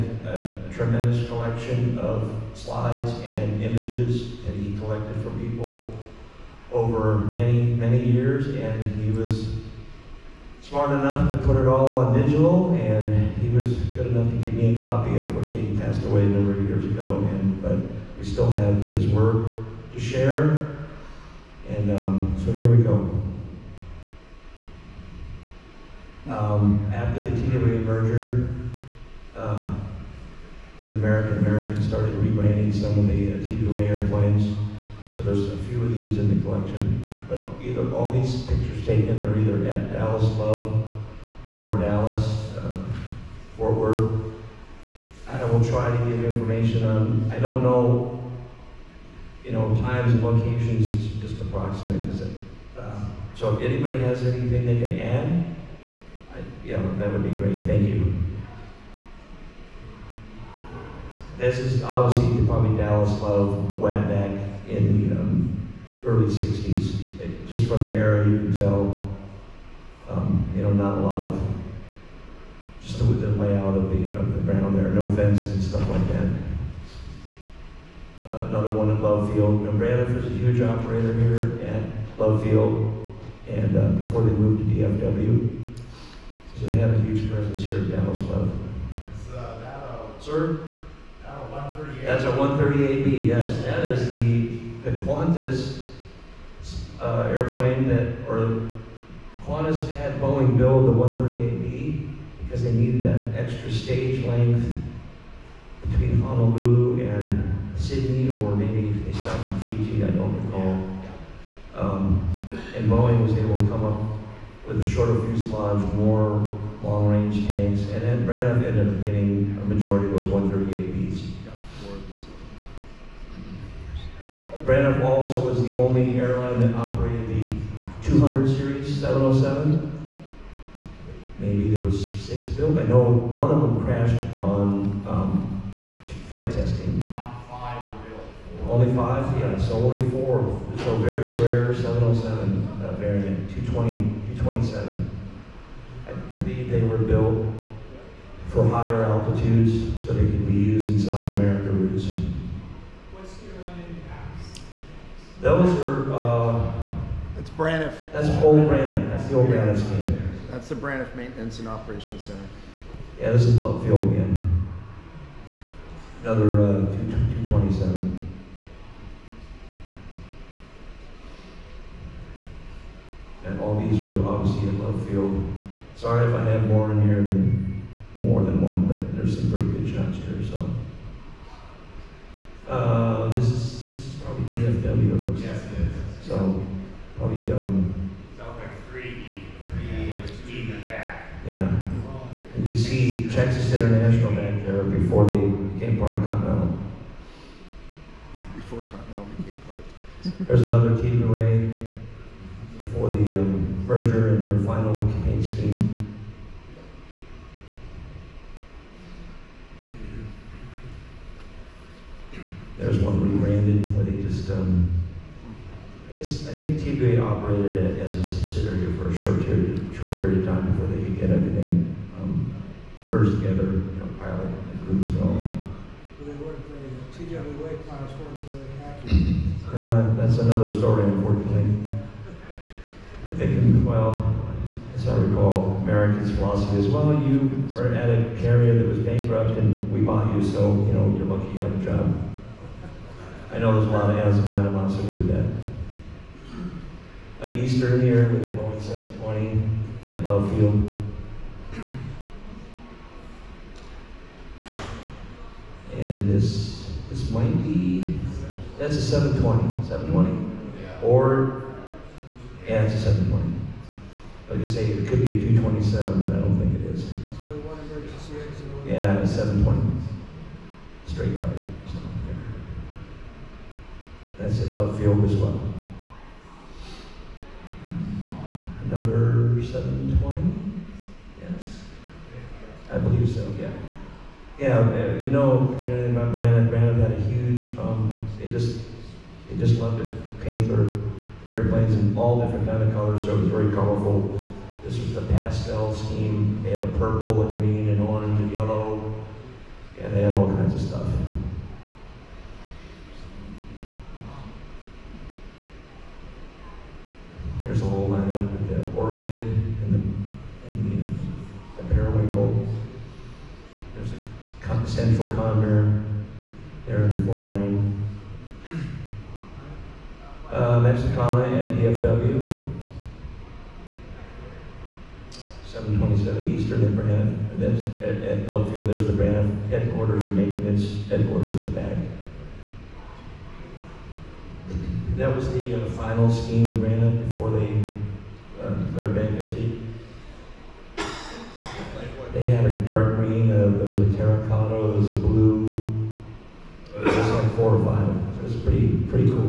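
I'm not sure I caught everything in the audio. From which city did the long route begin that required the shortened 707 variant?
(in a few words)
Honolulu.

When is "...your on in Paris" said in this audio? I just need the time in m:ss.
2:33.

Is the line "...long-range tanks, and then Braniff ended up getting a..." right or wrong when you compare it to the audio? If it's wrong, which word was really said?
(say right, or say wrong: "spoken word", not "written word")
right.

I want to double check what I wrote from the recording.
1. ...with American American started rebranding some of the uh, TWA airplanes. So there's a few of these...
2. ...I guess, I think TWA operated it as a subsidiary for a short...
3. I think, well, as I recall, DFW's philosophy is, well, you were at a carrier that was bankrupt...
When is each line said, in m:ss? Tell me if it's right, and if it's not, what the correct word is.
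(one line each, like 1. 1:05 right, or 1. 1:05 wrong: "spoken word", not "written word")
1. 0:30 right
2. 3:36 right
3. 3:53 wrong: "American", not "DFW".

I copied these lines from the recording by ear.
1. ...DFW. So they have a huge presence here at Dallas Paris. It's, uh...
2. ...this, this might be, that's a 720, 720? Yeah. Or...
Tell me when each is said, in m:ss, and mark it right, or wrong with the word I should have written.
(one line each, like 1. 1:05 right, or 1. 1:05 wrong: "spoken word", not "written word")
1. 1:24 wrong: "Love", not "Paris"
2. 4:16 right.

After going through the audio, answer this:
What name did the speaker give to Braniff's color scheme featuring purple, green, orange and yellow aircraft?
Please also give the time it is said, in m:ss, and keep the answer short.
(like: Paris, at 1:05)
pastel scheme, at 4:55.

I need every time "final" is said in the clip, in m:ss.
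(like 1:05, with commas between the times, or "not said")
3:24, 5:35.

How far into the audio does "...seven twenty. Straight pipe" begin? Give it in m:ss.
4:29.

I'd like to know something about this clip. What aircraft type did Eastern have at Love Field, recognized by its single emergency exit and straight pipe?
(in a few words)
Boeing 720.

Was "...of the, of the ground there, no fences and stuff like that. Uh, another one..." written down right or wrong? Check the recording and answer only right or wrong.
right.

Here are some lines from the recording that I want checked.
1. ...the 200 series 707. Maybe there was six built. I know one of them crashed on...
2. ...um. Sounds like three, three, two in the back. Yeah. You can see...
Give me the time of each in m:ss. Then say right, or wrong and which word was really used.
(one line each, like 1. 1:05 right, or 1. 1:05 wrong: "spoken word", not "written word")
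1. 2:08 right
2. 3:07 right.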